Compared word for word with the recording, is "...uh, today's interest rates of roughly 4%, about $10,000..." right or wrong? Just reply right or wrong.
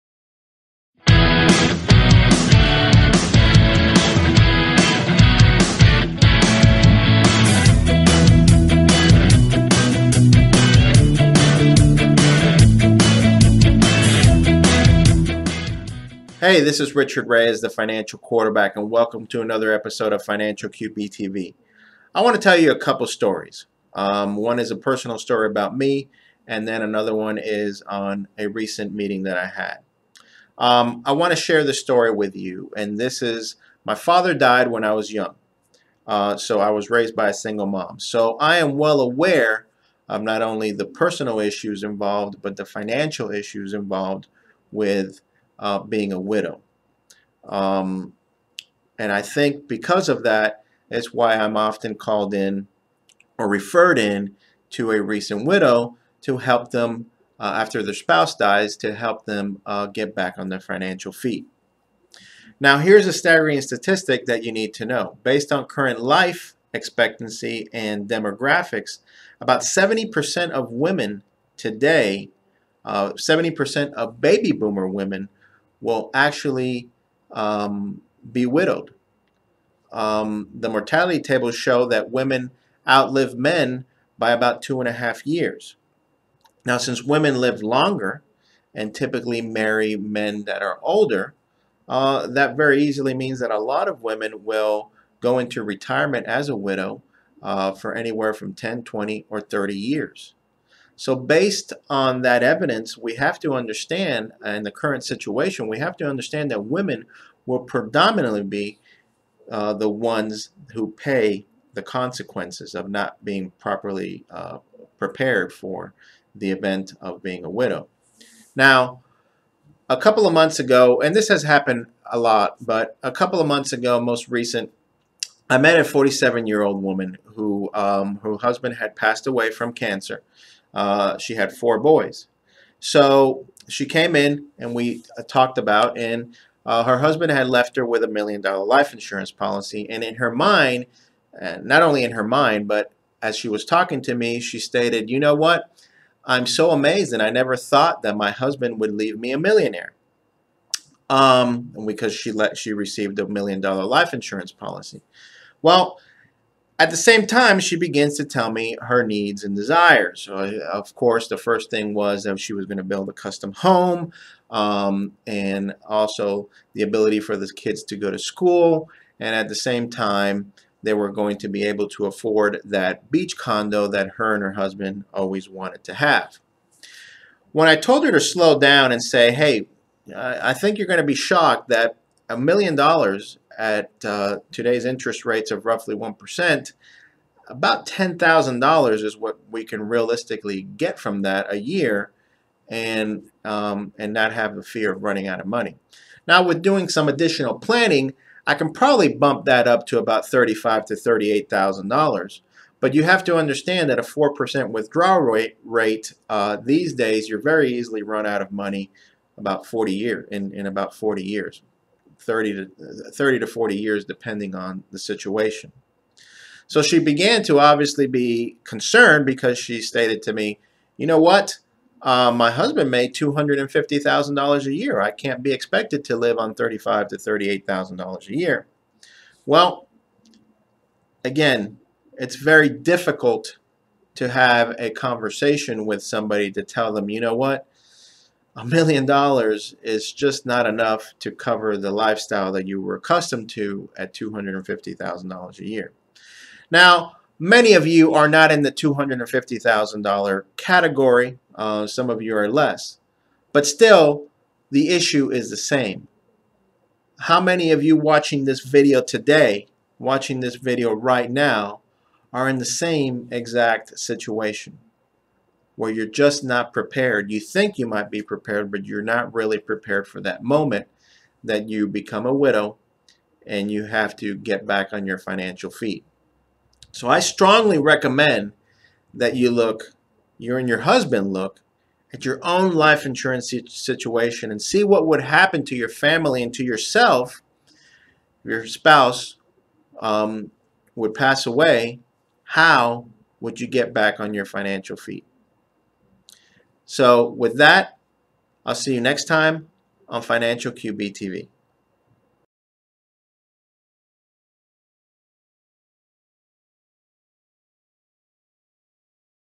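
wrong.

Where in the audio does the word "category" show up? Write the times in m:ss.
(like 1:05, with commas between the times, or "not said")
4:10.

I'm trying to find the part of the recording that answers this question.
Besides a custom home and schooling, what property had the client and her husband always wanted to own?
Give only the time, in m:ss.
2:53.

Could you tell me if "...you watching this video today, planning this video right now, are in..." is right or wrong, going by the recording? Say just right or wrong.
wrong.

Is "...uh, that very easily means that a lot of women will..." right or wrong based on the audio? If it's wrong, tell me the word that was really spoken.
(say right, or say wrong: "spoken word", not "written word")
right.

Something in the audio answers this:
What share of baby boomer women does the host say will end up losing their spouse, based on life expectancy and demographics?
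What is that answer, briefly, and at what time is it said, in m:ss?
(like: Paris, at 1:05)
70%, at 1:12.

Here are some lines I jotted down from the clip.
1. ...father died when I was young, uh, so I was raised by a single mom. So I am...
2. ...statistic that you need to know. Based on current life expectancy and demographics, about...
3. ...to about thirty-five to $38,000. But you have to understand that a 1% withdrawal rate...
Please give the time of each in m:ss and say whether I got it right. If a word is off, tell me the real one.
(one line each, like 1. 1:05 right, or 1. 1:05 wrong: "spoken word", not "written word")
1. 0:33 right
2. 1:03 right
3. 3:19 wrong: "4", not "1".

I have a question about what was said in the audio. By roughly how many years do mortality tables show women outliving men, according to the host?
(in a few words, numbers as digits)
2.5 years.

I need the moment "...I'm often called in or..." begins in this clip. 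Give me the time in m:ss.
0:51.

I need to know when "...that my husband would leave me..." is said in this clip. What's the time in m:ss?
2:28.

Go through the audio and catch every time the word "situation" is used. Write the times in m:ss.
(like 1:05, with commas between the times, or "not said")
1:45, 3:34, 4:23, 4:43.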